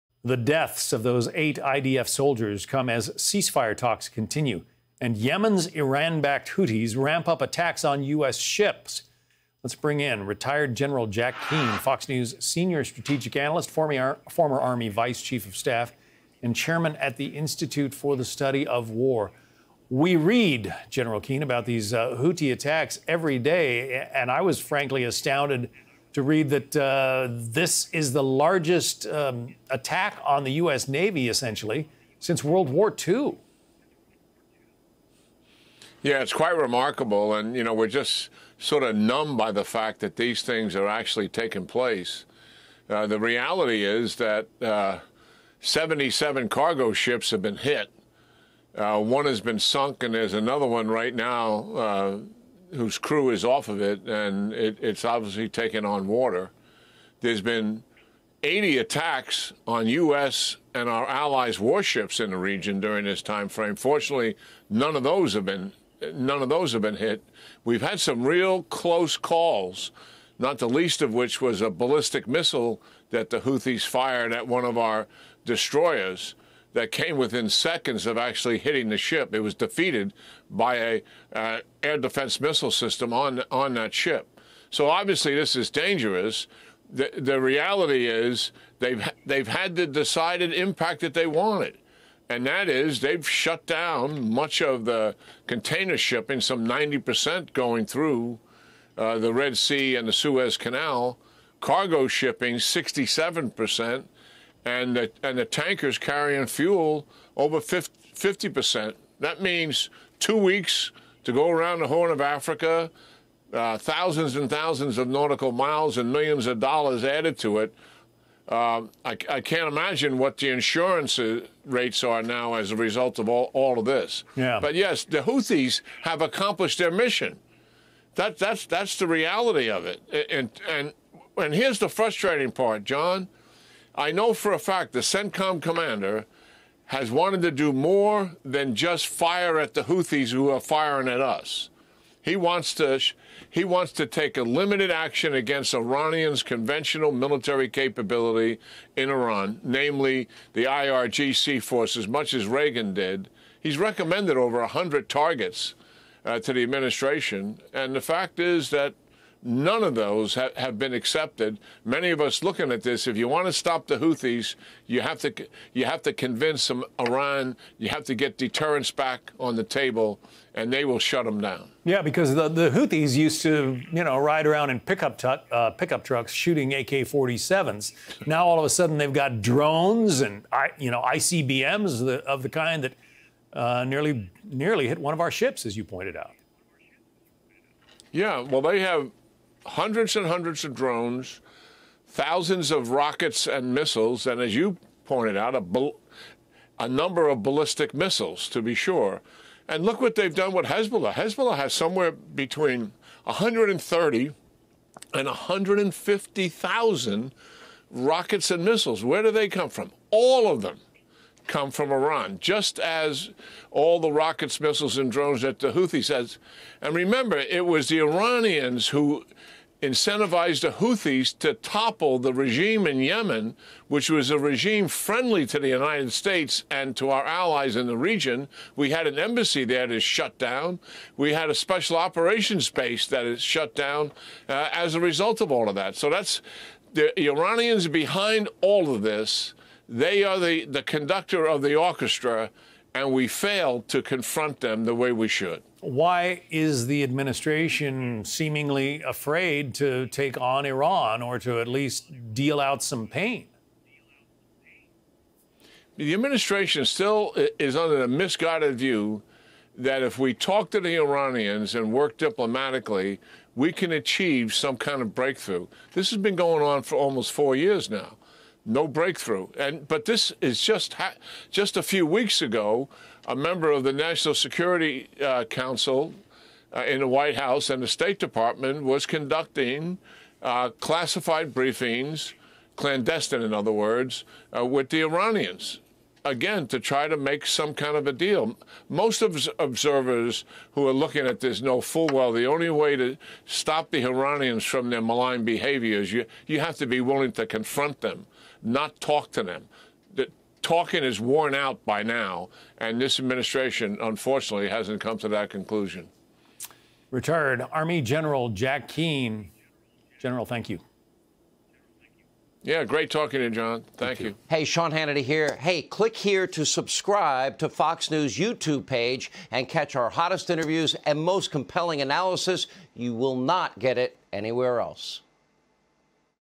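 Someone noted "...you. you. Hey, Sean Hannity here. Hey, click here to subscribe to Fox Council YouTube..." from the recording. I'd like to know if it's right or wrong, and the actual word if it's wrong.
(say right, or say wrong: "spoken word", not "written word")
wrong: "News", not "Council".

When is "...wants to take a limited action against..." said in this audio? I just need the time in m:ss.
2:23.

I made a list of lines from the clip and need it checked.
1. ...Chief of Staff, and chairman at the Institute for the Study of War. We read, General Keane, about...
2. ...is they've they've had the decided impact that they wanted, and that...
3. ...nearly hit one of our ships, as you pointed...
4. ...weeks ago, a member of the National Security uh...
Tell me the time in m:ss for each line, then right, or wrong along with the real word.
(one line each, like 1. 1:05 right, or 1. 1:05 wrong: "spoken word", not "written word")
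1. 0:15 right
2. 1:28 right
3. 3:04 right
4. 4:32 right.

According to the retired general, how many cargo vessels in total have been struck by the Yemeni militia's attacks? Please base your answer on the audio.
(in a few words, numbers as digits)
77.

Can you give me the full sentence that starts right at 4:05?
Why is the administration seemingly afraid to take on Iran or to at least deal out some pain?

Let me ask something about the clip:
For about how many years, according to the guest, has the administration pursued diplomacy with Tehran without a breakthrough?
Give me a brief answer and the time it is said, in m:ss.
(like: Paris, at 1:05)
almost four years, at 4:26.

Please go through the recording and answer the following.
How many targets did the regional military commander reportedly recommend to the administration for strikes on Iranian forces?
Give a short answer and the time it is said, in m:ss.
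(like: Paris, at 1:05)
over 100, at 2:34.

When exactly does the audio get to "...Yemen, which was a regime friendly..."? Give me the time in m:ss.
3:42.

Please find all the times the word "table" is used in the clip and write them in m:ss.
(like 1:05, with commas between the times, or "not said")
2:49.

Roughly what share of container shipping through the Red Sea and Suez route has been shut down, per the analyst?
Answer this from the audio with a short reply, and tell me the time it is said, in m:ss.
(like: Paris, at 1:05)
90%, at 1:36.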